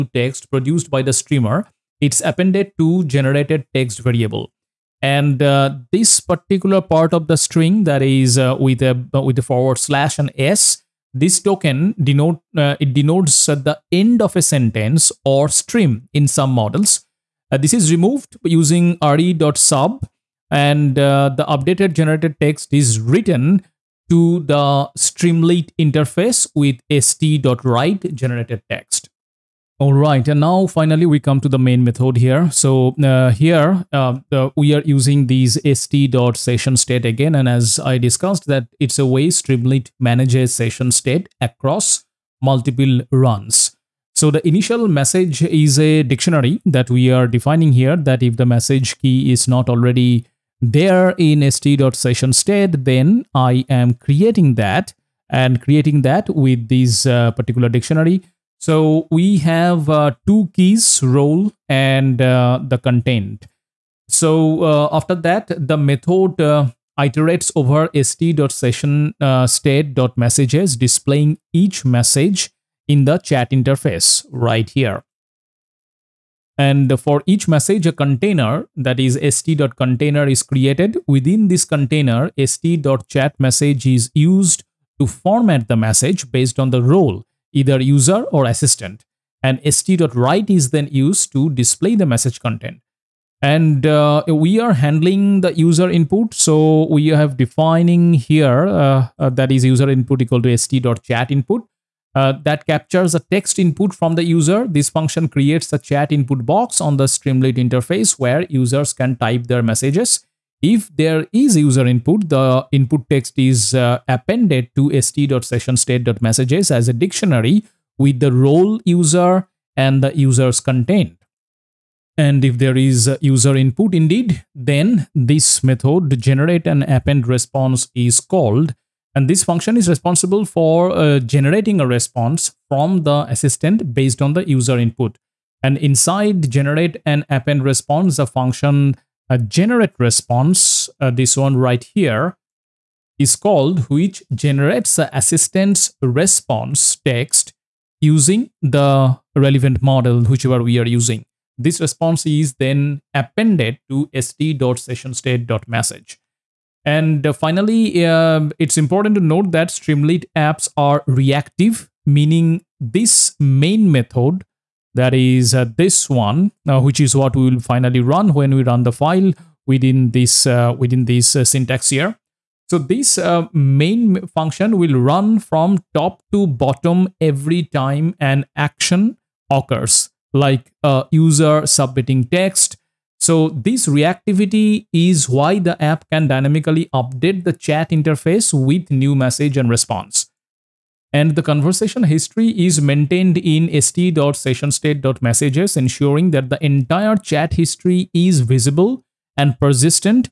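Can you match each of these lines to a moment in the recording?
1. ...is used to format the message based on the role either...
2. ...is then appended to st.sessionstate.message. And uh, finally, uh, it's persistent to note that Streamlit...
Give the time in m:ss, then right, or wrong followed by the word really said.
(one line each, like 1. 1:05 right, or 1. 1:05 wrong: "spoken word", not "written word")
1. 1:23 right
2. 2:32 wrong: "important", not "persistent".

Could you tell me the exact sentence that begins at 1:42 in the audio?
Uh, that captures a text input from the user.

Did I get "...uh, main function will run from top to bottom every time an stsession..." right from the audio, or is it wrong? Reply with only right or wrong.
wrong.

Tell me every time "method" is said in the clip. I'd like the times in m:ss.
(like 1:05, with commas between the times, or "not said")
0:31, 1:05, 2:05, 2:43.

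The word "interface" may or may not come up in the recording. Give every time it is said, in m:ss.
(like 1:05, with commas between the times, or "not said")
0:25, 1:13, 1:47, 3:07.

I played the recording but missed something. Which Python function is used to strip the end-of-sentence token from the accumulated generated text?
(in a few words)
re.sub.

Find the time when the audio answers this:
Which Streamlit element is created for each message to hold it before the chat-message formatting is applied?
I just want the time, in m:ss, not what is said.
1:19.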